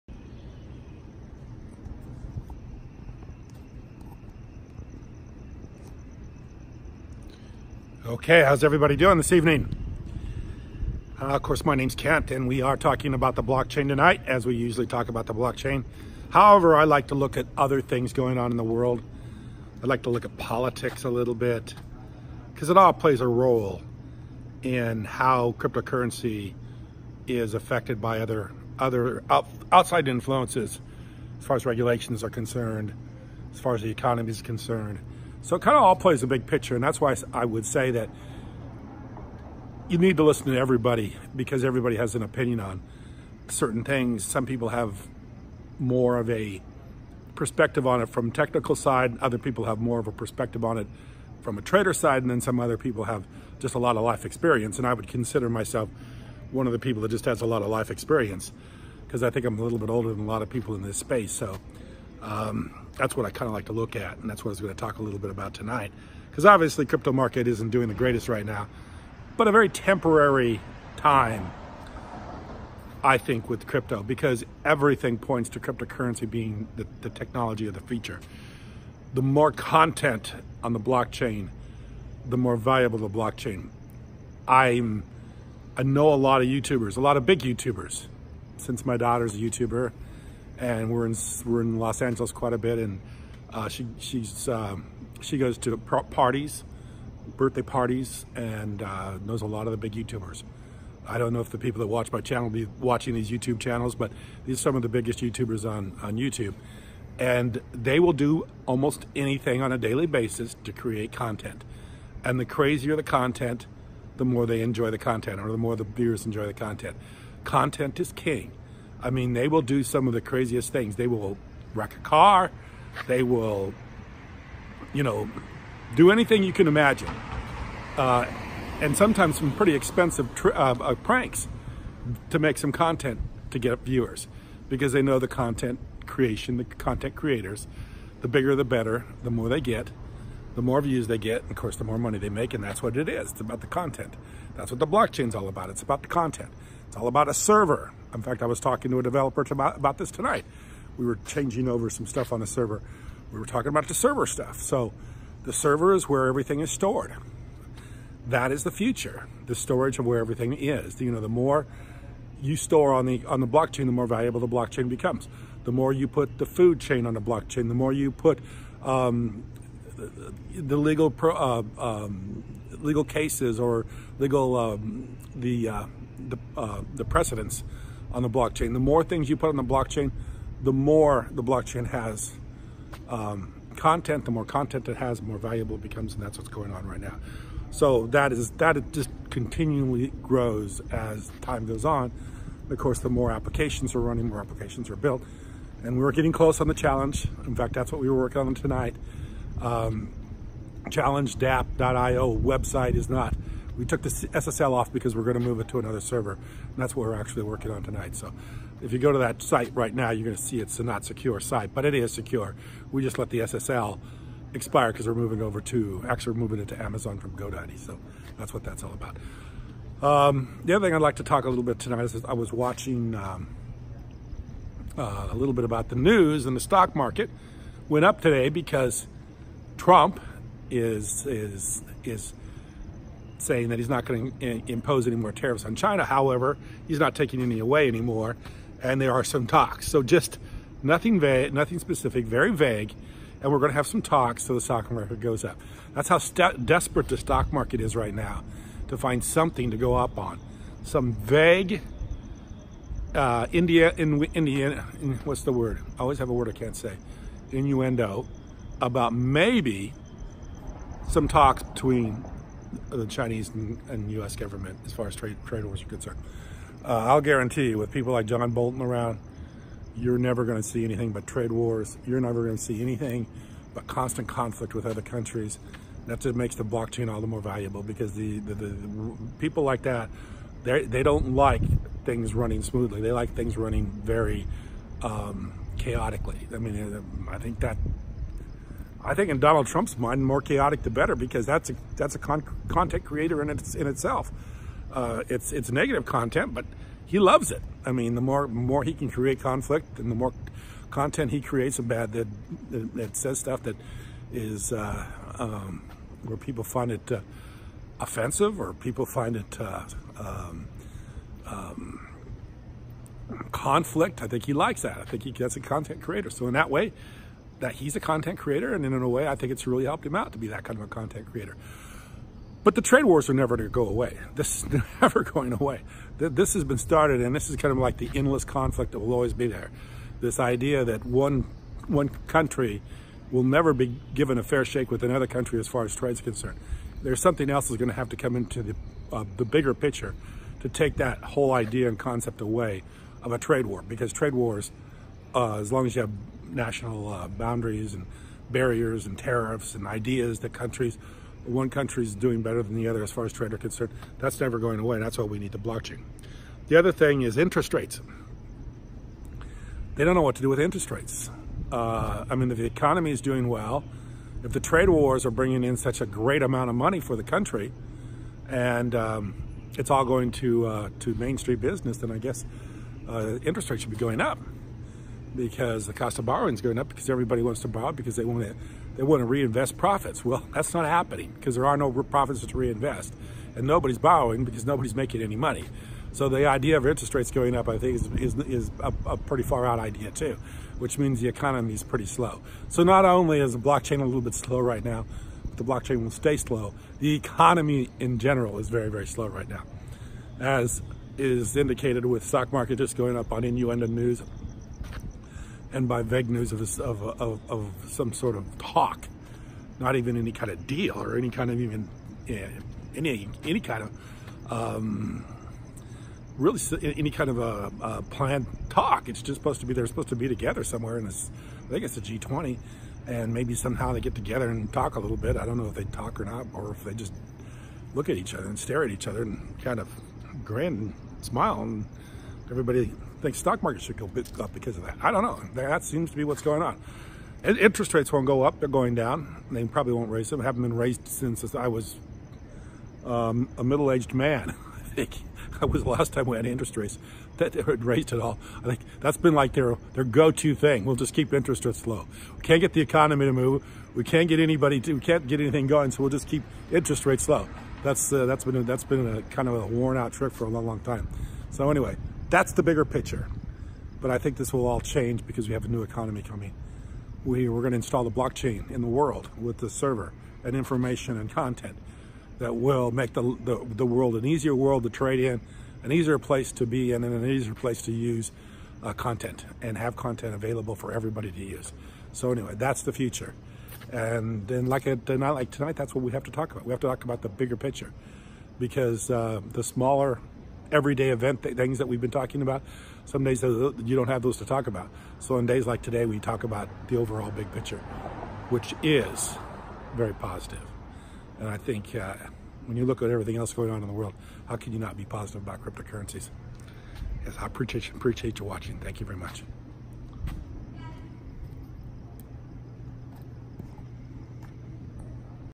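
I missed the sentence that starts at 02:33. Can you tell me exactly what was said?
We were talking about the server stuff.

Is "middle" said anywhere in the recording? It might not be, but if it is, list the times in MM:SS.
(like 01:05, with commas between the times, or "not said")
07:23.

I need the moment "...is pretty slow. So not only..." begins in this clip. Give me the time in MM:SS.
06:31.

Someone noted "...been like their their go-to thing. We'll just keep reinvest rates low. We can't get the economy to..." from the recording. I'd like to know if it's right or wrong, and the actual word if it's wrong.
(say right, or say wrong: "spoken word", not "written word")
wrong: "interest", not "reinvest".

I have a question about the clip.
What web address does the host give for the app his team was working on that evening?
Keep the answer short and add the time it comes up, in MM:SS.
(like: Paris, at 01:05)
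challengedapp.io, at 03:20.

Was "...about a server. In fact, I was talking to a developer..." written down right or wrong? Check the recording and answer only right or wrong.
right.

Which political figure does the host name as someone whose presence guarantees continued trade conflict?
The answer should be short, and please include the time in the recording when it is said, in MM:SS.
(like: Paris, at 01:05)
John Bolton, at 04:28.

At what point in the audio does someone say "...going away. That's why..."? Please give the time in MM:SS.
05:54.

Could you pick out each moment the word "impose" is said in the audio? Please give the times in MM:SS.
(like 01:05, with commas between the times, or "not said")
03:54.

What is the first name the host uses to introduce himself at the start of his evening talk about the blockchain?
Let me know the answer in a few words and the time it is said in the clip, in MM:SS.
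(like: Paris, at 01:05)
Kent, at 00:11.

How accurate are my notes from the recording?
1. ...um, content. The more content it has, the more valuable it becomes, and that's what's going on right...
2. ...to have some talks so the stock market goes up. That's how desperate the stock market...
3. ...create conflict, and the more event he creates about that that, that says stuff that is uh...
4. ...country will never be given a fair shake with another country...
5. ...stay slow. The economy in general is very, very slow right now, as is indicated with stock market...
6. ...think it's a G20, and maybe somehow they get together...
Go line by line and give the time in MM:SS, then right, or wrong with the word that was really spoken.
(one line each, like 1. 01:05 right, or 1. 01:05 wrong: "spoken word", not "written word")
1. 03:03 right
2. 04:03 right
3. 04:59 wrong: "content", not "event"
4. 05:32 right
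5. 06:36 right
6. 07:01 right.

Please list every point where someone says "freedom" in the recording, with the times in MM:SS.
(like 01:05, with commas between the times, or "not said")
not said.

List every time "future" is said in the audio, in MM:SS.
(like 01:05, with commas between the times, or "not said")
01:17, 02:38, 08:02.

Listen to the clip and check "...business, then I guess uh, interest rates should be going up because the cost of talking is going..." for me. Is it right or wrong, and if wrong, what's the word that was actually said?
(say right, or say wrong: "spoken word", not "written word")
wrong: "borrowing", not "talking".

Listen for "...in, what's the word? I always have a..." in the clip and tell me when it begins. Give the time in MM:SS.
04:15.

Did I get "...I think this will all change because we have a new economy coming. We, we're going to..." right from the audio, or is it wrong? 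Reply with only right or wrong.
right.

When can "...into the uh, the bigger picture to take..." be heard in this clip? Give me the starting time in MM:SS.
05:38.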